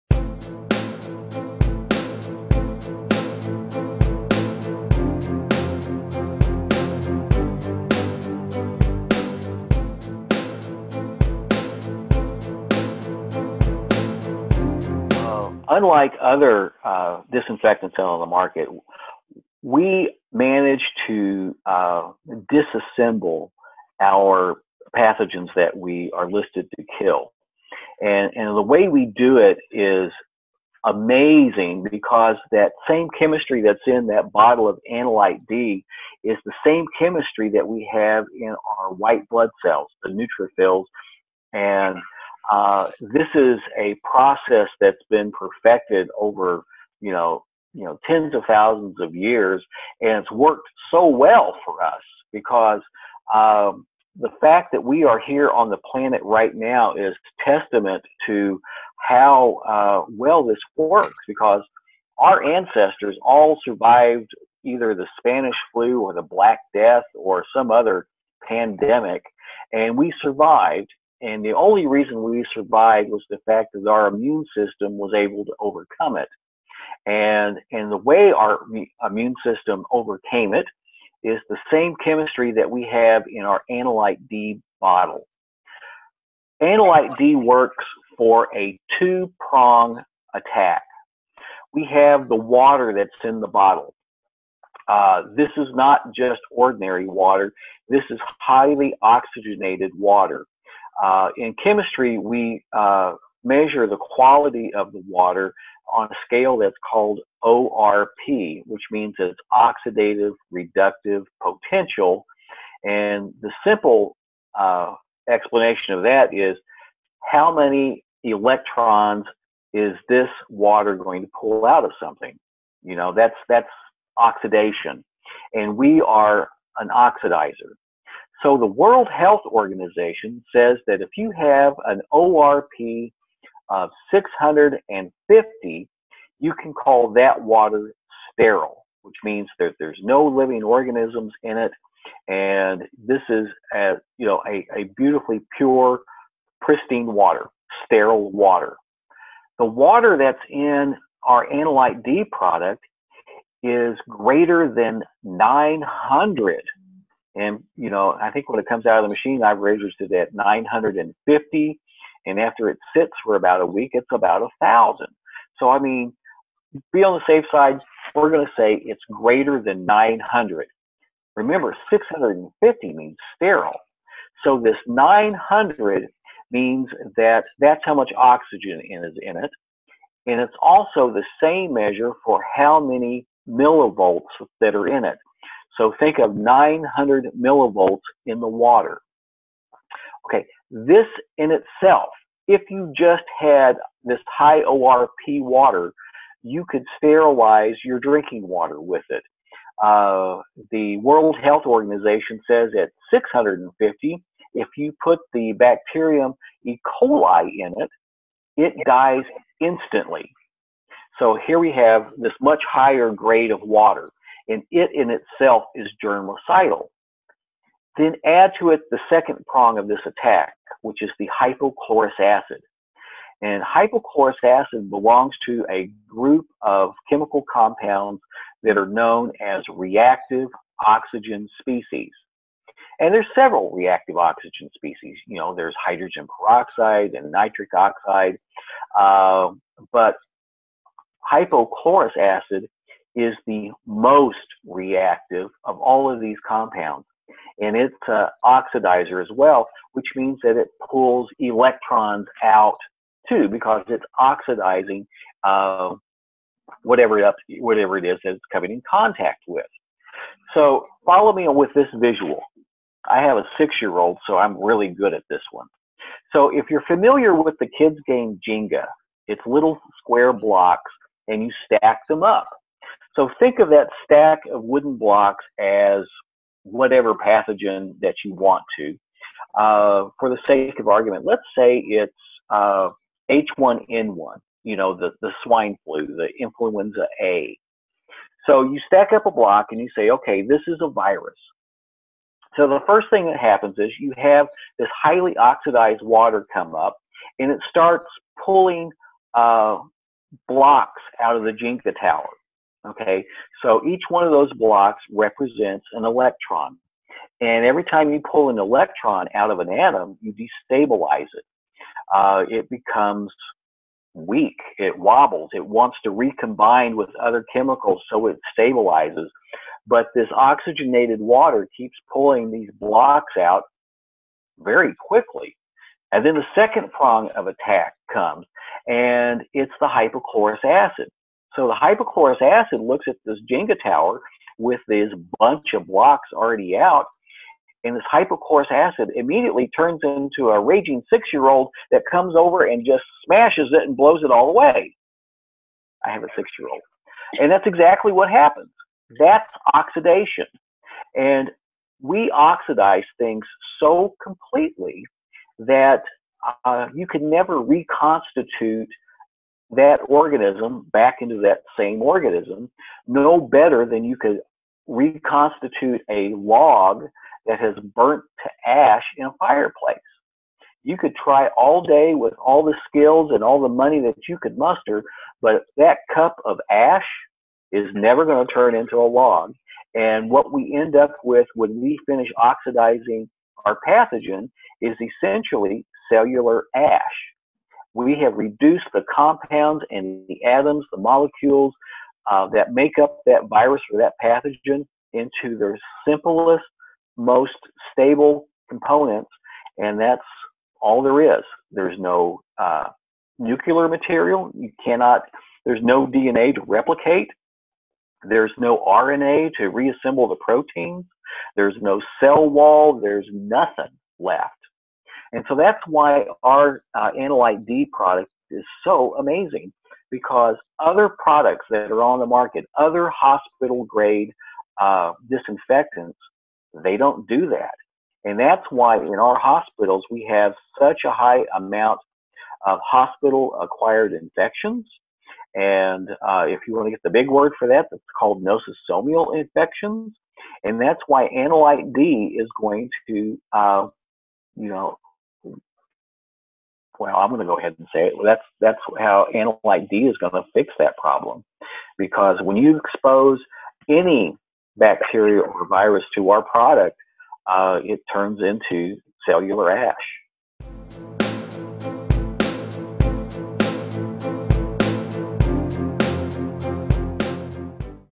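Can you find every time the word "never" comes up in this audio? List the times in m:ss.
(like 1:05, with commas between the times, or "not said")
5:57, 6:17.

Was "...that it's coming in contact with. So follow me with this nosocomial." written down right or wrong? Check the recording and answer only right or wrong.
wrong.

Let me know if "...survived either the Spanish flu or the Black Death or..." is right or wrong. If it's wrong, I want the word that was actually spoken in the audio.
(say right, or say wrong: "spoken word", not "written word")
right.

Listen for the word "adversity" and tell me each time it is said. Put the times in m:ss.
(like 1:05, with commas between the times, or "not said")
not said.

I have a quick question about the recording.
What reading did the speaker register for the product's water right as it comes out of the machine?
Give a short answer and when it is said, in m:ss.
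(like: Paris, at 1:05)
950, at 2:40.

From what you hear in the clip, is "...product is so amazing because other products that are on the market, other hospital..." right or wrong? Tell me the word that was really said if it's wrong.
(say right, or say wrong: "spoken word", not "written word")
right.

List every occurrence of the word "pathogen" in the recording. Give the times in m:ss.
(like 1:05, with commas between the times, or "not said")
0:24, 4:37, 6:23, 6:34.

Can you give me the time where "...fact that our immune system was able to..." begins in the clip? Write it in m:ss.
1:13.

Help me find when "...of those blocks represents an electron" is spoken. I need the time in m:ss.
5:04.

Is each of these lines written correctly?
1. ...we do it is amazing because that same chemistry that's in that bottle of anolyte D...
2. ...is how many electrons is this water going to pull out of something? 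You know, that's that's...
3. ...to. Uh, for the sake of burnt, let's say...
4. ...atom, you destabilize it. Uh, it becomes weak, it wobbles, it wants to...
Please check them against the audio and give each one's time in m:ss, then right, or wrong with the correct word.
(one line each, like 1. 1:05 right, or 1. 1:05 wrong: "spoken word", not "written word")
1. 0:28 right
2. 1:56 right
3. 4:38 wrong: "argument", not "burnt"
4. 5:09 right.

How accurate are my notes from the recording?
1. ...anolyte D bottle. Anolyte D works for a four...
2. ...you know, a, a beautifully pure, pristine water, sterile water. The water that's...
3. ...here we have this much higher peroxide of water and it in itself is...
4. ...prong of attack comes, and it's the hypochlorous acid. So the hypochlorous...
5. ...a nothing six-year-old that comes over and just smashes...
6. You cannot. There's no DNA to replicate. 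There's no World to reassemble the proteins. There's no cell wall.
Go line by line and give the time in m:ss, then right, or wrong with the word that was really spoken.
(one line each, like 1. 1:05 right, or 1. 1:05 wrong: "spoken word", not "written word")
1. 1:23 wrong: "two", not "four"
2. 2:24 right
3. 3:31 wrong: "grade", not "peroxide"
4. 5:26 right
5. 5:40 wrong: "raging", not "nothing"
6. 6:44 wrong: "RNA", not "World".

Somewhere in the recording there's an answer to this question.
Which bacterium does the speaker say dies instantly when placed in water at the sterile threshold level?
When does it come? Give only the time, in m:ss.
3:26.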